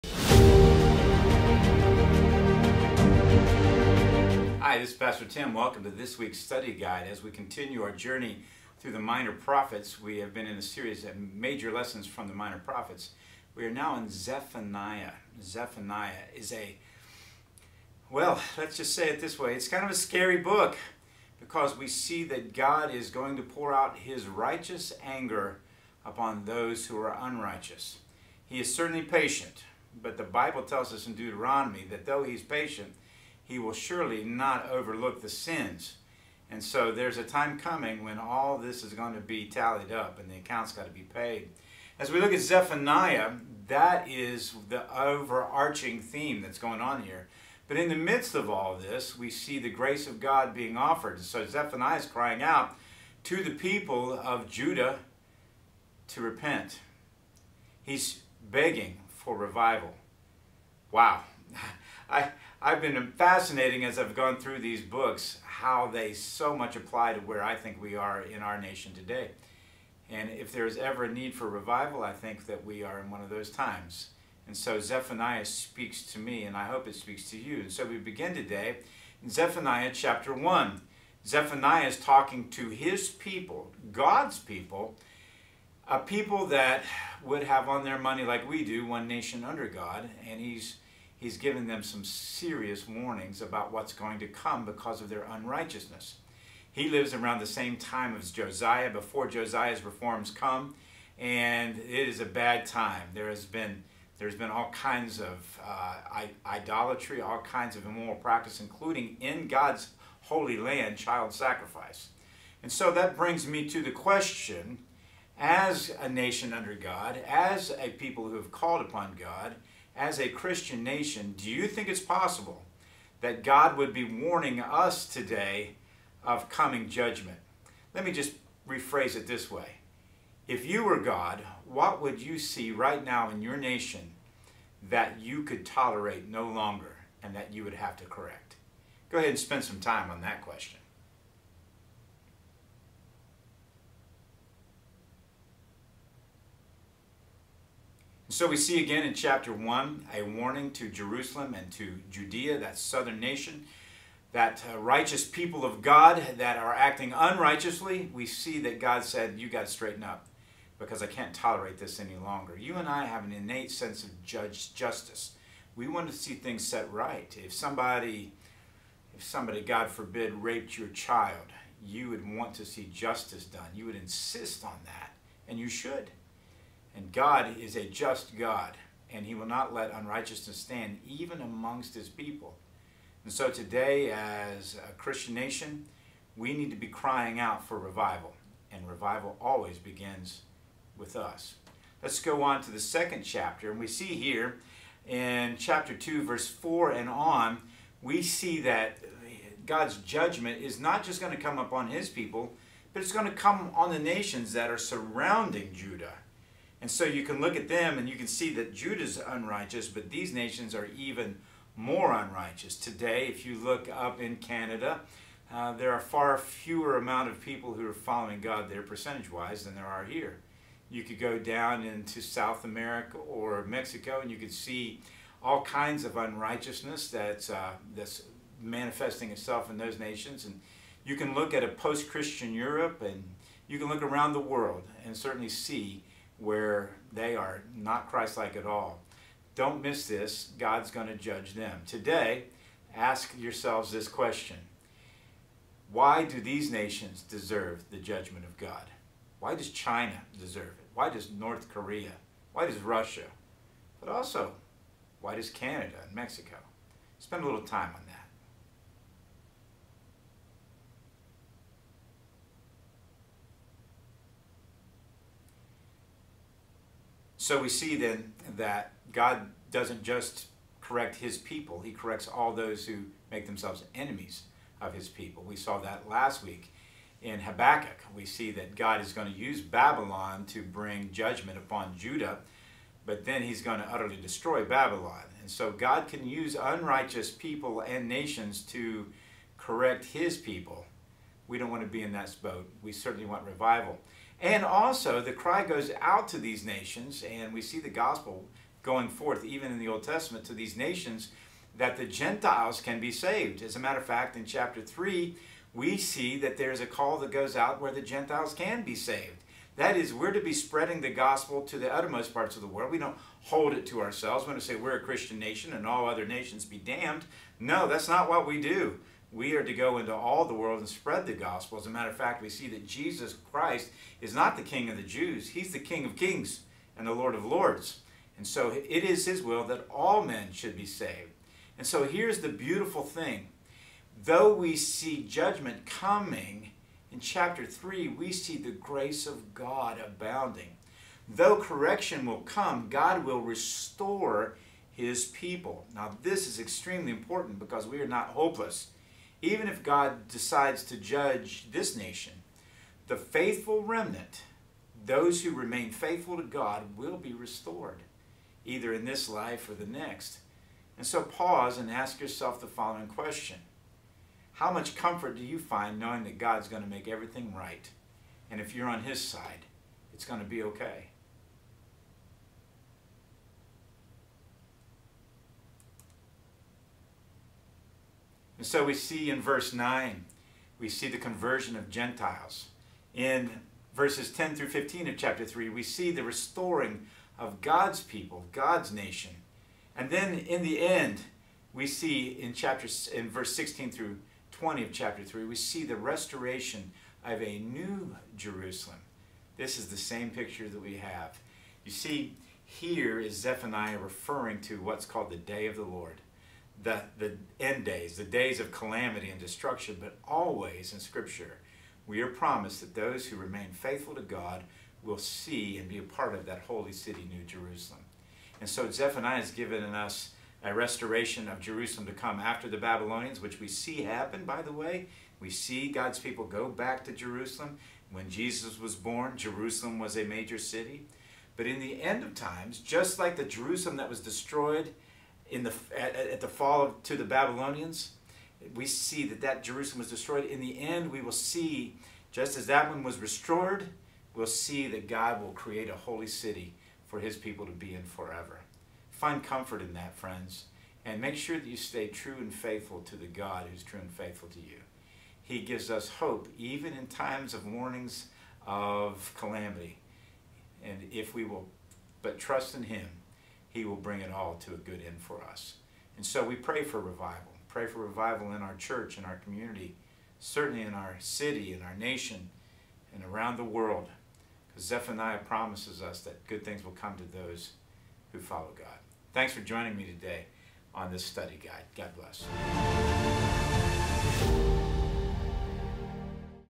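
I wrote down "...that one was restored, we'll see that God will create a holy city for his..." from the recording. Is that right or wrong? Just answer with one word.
right.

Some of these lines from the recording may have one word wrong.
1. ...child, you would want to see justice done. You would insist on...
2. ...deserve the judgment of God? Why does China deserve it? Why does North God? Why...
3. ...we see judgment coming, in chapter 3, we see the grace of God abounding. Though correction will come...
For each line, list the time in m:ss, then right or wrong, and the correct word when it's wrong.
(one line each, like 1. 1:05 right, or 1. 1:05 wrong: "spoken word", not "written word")
1. 2:50 right
2. 4:07 wrong: "Korea", not "God"
3. 5:34 right.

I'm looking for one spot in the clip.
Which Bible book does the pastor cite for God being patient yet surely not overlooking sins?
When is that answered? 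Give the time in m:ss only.
0:31.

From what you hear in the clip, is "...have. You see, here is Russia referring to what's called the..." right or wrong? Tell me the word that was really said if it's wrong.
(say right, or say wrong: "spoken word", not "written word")
wrong: "Zephaniah", not "Russia".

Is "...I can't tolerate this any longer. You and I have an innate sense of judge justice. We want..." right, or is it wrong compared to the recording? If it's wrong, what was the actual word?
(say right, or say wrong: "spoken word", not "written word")
right.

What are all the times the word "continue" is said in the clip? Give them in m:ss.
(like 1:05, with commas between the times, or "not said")
0:07.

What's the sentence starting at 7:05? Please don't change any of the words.
We see God's people go back to Jerusalem.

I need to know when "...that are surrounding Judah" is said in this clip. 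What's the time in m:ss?
3:24.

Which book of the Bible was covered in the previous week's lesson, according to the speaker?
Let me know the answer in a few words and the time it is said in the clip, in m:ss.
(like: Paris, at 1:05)
Habakkuk, at 4:37.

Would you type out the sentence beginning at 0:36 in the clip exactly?
And so there's a time coming when all this is going to be tallied up and the account's got to be paid.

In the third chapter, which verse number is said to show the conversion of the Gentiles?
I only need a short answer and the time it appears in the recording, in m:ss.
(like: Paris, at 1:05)
9, at 6:19.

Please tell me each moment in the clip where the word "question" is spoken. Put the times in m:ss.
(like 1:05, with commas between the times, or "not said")
1:53, 2:20, 4:04, 6:03.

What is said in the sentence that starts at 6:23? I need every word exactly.
In verses 10 through 15 of chapter 3, we see the restoring of God's people, God's nation.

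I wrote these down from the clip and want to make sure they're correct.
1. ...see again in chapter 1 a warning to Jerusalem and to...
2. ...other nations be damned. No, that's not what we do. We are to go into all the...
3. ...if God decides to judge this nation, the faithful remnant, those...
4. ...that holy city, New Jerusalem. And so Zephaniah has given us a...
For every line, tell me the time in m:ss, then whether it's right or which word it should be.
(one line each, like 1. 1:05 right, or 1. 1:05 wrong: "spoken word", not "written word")
1. 2:28 right
2. 5:16 right
3. 5:49 right
4. 6:56 right.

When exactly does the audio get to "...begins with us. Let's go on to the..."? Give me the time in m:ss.
3:09.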